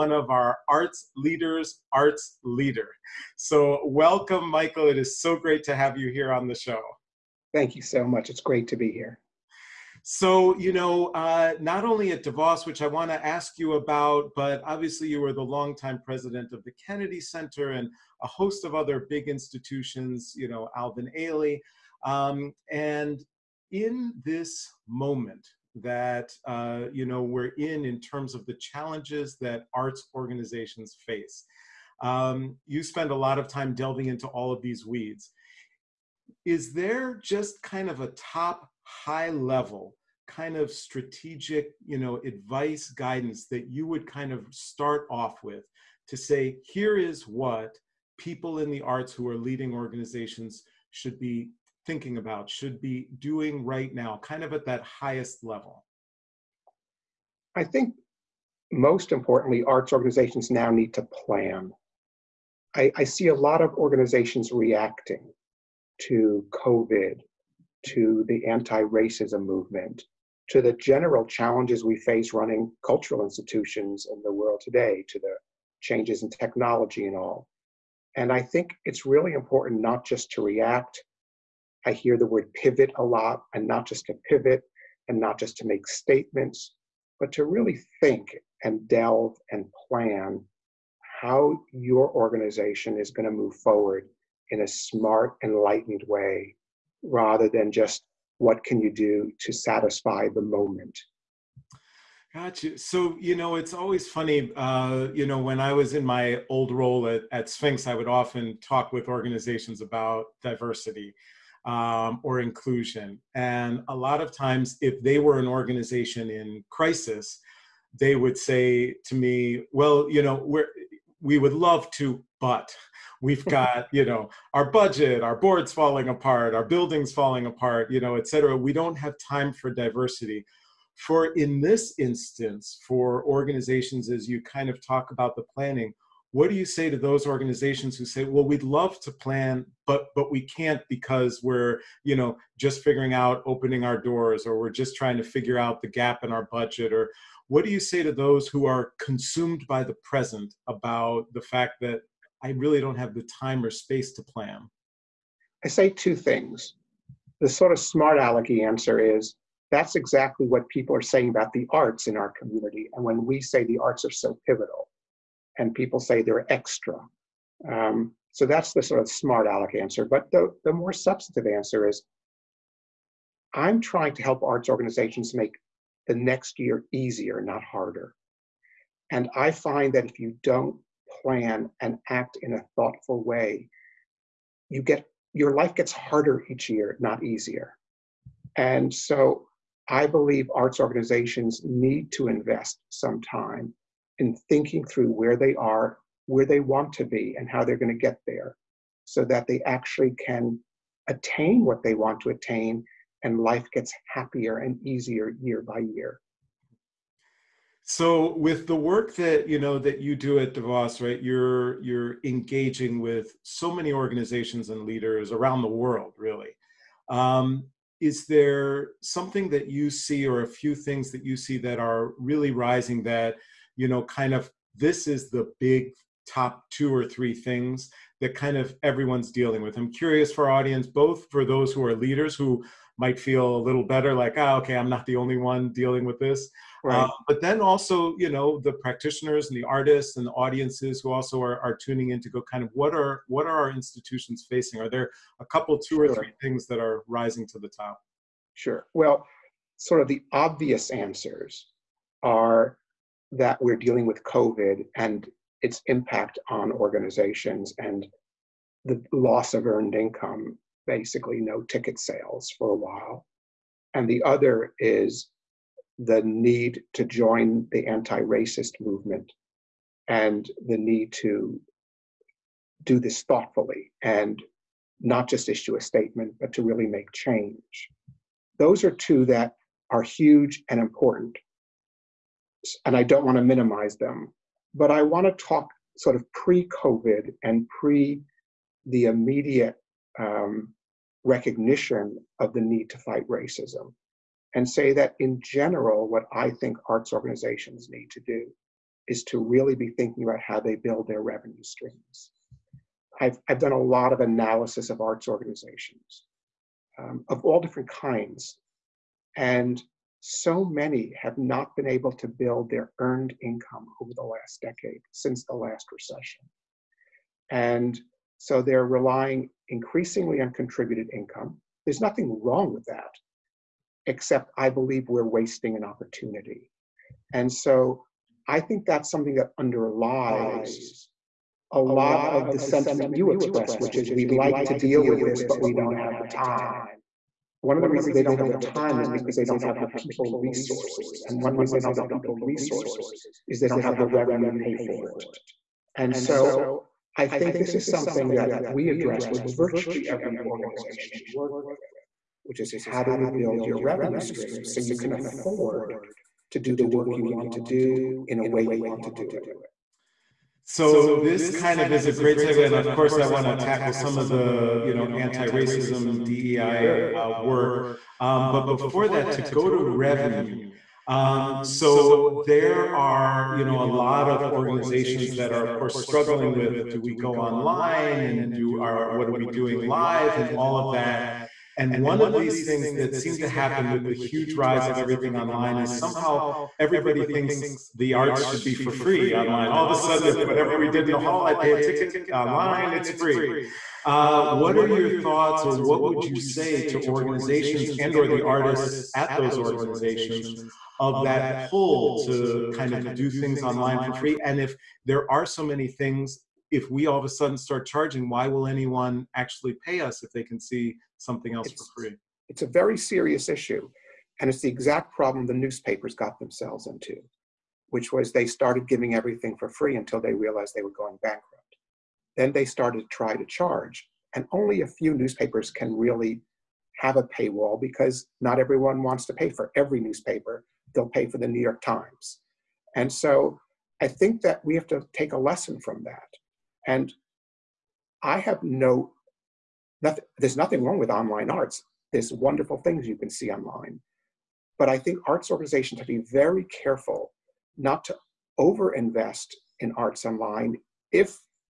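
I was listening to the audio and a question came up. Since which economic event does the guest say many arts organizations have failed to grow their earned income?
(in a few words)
the last recession.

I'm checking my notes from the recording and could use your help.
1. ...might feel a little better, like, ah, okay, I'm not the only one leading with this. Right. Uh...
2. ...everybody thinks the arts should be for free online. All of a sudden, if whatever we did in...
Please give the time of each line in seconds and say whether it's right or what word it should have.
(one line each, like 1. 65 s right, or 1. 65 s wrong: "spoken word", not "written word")
1. 233 s wrong: "dealing", not "leading"
2. 386 s right.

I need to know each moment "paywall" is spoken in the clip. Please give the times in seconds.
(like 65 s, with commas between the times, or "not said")
427 s.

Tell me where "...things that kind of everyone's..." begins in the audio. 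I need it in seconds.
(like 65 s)
227 s.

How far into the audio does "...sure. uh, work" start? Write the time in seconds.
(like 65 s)
366 s.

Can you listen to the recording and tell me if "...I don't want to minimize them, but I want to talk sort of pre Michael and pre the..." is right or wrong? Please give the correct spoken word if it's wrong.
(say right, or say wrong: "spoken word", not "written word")
wrong: "COVID", not "Michael".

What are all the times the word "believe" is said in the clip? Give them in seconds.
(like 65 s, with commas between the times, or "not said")
190 s, 324 s.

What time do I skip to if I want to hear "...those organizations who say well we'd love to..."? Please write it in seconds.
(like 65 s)
136 s.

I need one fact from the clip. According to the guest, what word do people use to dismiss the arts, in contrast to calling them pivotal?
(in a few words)
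extra.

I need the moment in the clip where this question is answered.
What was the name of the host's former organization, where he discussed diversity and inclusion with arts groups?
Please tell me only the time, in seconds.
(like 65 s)
107 s.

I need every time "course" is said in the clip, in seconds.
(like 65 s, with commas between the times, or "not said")
362 s, 375 s.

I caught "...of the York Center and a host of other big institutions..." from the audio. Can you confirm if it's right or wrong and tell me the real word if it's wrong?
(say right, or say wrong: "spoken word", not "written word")
wrong: "Kennedy", not "York".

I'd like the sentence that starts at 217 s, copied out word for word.
Um, is there something that you see, or a few things that you see that are really rising?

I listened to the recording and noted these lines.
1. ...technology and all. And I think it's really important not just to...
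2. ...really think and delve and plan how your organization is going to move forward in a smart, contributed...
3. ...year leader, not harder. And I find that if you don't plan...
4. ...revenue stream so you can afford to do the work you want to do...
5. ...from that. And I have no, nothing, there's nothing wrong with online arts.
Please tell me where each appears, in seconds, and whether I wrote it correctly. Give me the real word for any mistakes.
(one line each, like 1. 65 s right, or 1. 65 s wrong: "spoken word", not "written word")
1. 76 s right
2. 87 s wrong: "enlightened", not "contributed"
3. 176 s wrong: "easier", not "leader"
4. 353 s right
5. 435 s right.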